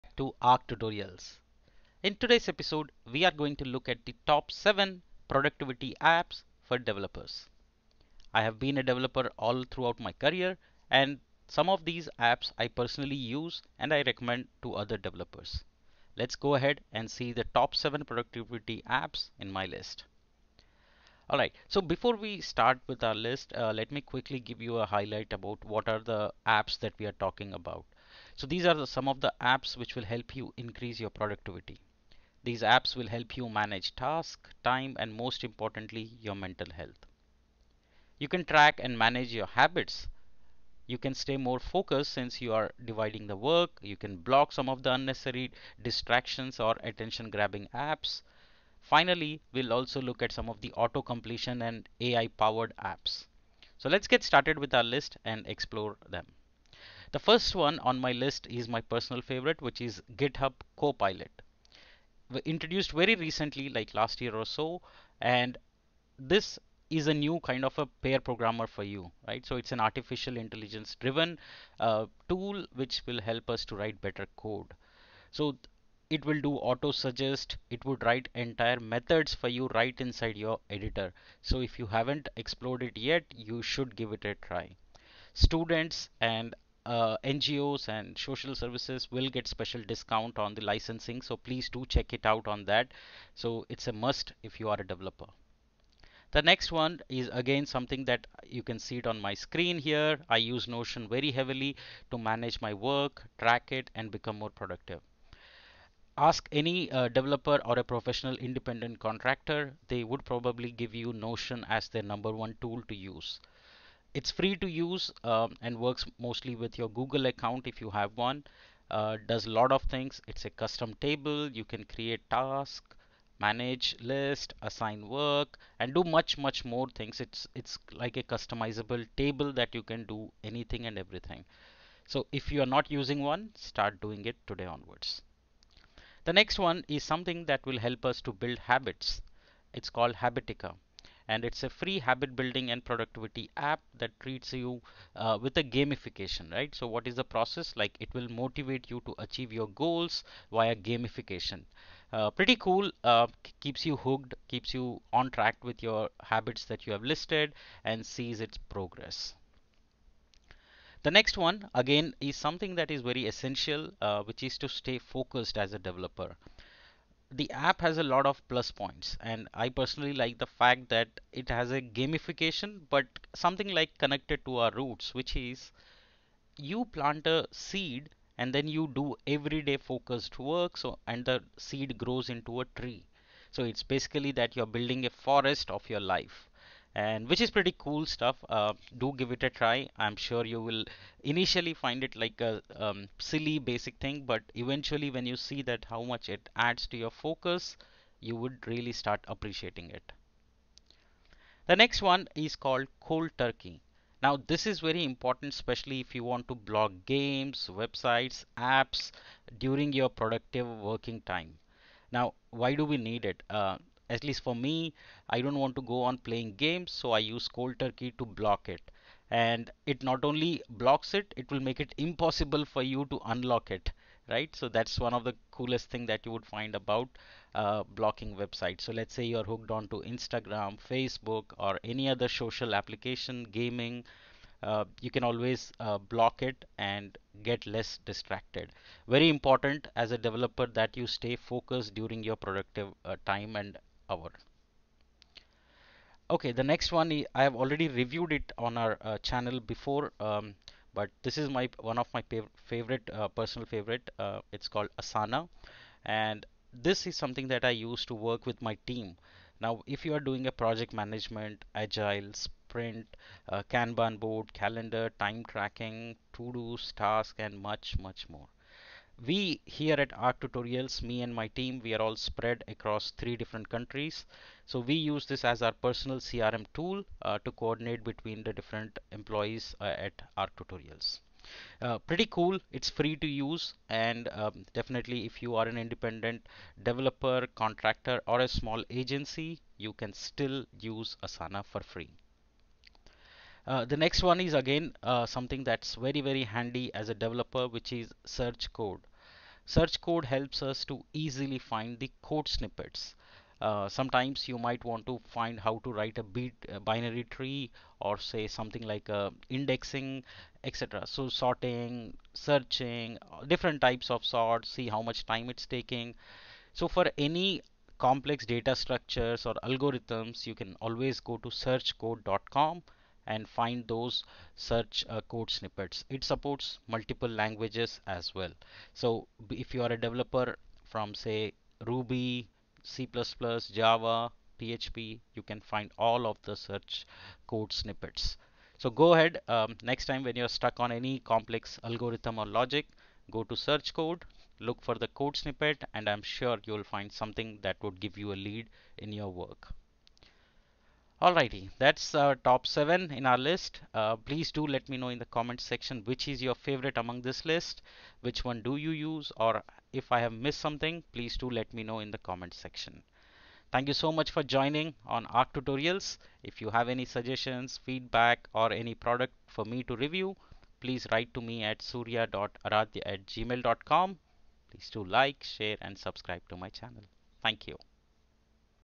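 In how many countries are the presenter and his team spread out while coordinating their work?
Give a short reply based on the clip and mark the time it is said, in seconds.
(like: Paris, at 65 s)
3, at 273 s.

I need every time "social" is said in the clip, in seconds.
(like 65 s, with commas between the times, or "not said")
88 s, 232 s.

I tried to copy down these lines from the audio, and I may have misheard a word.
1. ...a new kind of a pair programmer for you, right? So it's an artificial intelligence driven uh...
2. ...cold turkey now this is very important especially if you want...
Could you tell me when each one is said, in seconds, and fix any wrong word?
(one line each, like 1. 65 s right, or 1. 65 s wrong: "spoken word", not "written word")
1. 67 s right
2. 202 s right.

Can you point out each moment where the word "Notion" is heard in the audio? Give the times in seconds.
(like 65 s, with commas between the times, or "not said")
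100 s, 111 s.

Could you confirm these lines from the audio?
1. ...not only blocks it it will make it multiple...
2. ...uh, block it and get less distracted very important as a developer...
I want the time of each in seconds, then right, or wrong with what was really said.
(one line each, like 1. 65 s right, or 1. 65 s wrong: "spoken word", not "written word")
1. 220 s wrong: "impossible", not "multiple"
2. 235 s right.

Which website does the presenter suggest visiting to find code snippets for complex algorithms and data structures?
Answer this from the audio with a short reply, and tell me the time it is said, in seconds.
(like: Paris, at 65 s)
searchcode.com, at 321 s.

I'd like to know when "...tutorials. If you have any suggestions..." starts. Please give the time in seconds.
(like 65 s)
365 s.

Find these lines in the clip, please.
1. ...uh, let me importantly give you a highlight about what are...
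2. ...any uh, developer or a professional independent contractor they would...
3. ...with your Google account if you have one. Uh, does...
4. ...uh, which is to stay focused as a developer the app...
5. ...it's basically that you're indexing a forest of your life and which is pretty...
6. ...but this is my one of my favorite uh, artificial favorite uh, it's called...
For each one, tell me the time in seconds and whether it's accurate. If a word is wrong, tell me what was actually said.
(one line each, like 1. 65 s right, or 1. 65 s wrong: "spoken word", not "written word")
1. 23 s wrong: "quickly", not "importantly"
2. 106 s right
3. 116 s right
4. 164 s right
5. 183 s wrong: "building", not "indexing"
6. 250 s wrong: "personal", not "artificial".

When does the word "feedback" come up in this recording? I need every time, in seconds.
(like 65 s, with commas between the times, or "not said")
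367 s.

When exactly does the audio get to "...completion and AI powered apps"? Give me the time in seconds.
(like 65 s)
51 s.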